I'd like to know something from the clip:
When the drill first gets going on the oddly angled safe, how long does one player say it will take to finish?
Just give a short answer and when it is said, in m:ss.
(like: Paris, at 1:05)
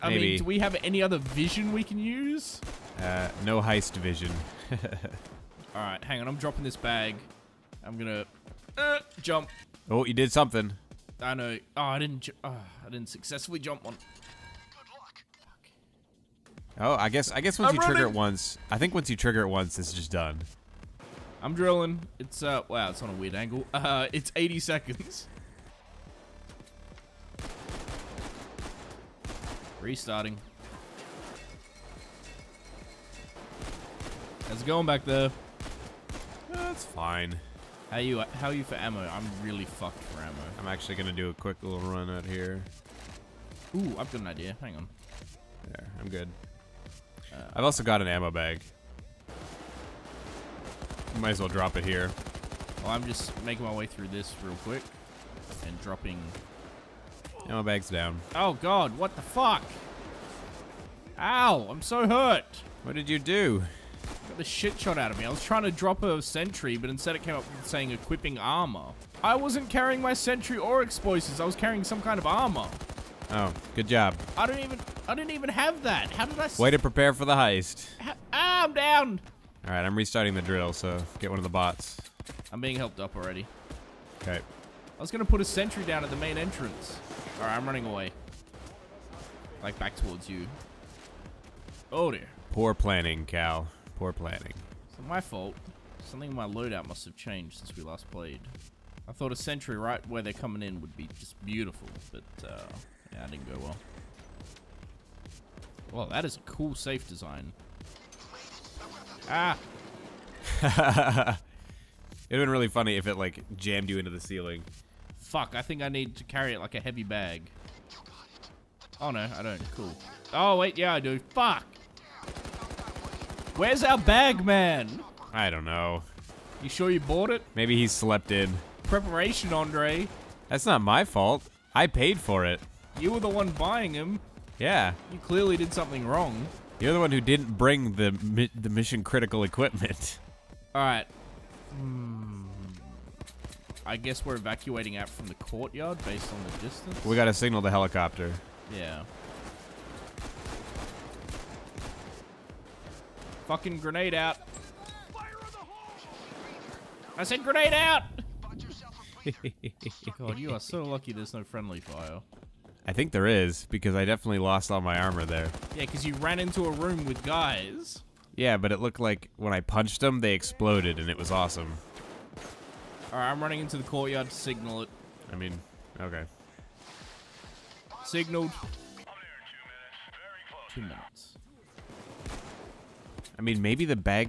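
80 seconds, at 0:24.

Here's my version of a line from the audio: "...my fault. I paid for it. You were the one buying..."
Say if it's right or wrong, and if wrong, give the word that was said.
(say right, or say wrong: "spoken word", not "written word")
right.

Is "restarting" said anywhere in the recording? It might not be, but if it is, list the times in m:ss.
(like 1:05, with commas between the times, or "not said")
0:29, 1:19.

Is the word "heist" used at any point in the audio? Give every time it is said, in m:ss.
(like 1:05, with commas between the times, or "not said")
0:03, 1:17.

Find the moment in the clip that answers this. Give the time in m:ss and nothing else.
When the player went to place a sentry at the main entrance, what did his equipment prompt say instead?
1:07.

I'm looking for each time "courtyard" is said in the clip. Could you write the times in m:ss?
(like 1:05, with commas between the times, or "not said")
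2:25, 2:53.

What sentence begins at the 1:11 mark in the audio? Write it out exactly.
I was carrying some kind of armor.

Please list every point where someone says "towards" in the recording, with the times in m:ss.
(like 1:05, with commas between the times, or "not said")
1:29.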